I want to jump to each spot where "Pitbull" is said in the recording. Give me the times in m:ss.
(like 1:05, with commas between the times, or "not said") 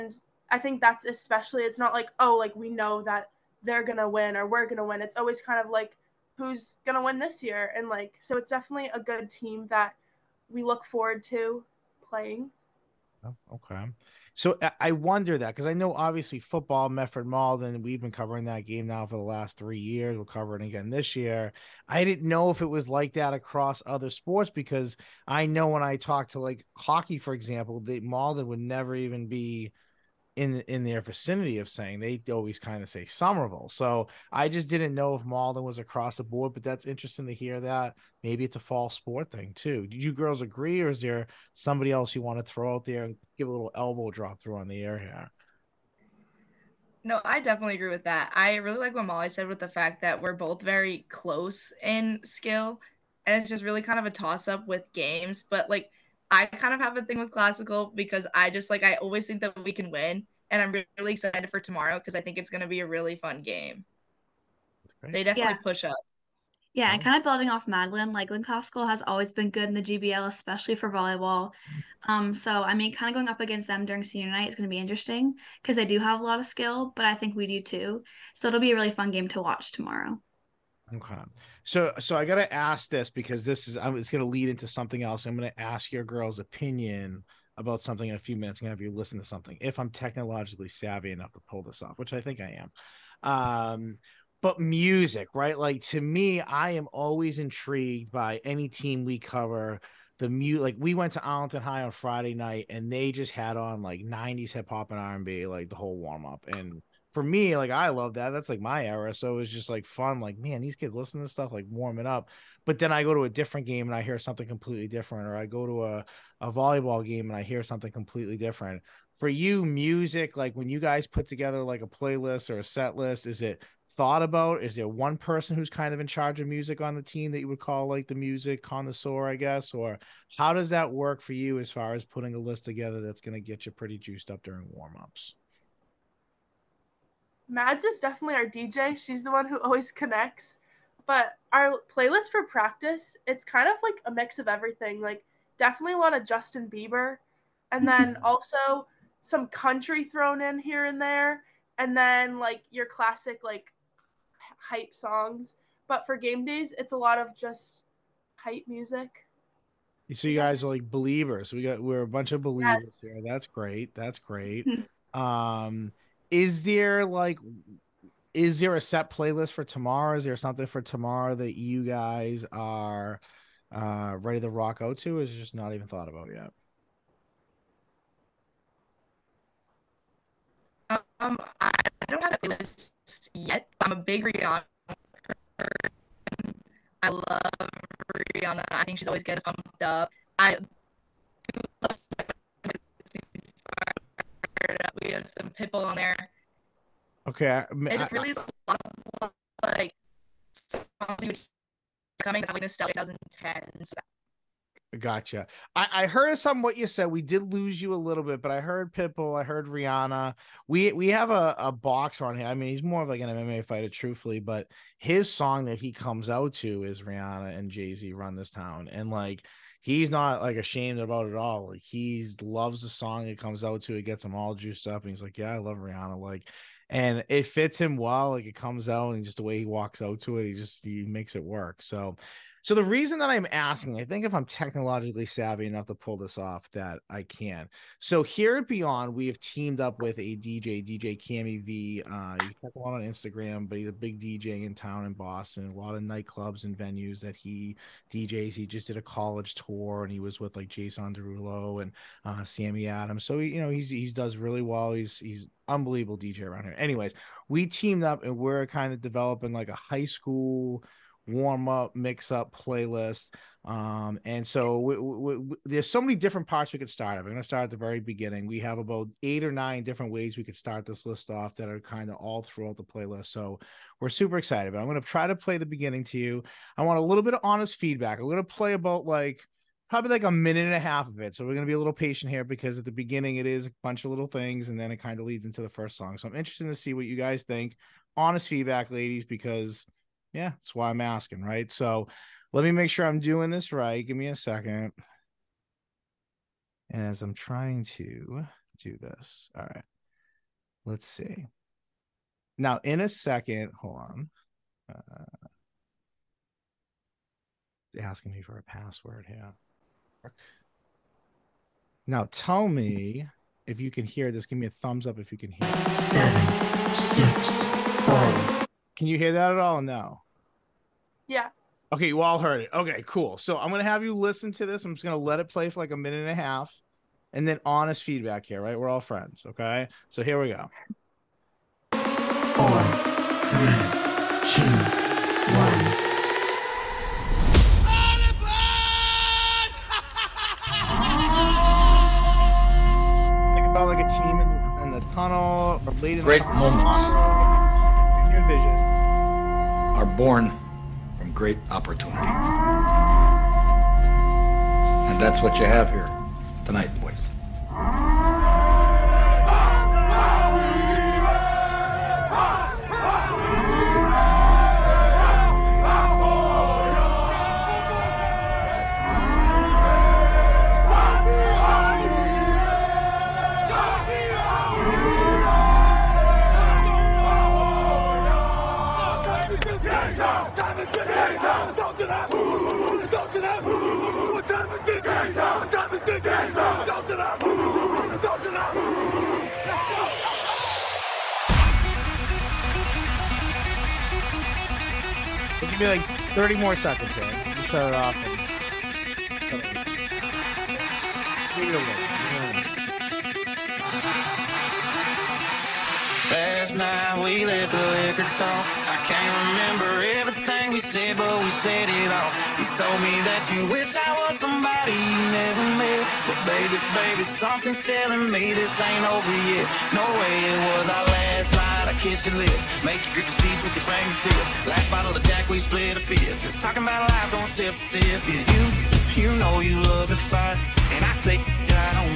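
3:15, 3:28.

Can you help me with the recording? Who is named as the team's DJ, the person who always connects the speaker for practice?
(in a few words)
Mads.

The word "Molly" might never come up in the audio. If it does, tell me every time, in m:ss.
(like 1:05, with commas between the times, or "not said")
0:49.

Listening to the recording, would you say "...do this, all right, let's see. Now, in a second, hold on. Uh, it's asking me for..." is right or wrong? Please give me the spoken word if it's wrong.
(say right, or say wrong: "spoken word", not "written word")
right.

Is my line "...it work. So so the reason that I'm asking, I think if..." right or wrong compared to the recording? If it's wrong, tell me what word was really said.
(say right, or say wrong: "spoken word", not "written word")
right.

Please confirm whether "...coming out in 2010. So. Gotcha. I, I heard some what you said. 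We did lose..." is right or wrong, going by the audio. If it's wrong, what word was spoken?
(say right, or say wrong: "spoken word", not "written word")
right.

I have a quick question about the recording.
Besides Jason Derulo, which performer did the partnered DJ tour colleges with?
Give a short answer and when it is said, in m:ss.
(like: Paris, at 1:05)
Sammy Adams, at 4:12.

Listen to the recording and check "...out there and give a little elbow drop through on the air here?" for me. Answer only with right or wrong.
right.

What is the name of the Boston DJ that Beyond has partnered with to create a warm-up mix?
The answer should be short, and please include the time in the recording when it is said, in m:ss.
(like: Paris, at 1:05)
DJ Cami V, at 4:00.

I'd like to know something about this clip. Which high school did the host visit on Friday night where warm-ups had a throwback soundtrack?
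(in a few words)
Arlington High.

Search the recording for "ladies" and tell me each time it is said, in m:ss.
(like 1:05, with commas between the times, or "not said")
4:48.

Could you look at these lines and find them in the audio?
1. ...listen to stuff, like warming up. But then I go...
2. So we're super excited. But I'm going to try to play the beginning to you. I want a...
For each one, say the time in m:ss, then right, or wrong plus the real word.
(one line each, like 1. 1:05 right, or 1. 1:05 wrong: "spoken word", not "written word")
1. 1:50 right
2. 4:33 right.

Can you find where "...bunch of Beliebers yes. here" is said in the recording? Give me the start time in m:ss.
2:42.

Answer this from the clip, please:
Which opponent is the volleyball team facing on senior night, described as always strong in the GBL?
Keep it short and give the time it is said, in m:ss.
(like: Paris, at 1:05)
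Lynn Classical, at 1:08.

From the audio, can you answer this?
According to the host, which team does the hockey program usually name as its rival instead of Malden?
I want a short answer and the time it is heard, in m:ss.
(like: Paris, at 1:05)
Somerville, at 0:33.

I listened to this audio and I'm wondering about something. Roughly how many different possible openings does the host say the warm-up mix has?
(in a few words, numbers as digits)
8 or 9.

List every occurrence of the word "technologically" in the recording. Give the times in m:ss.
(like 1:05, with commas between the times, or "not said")
1:29, 3:54.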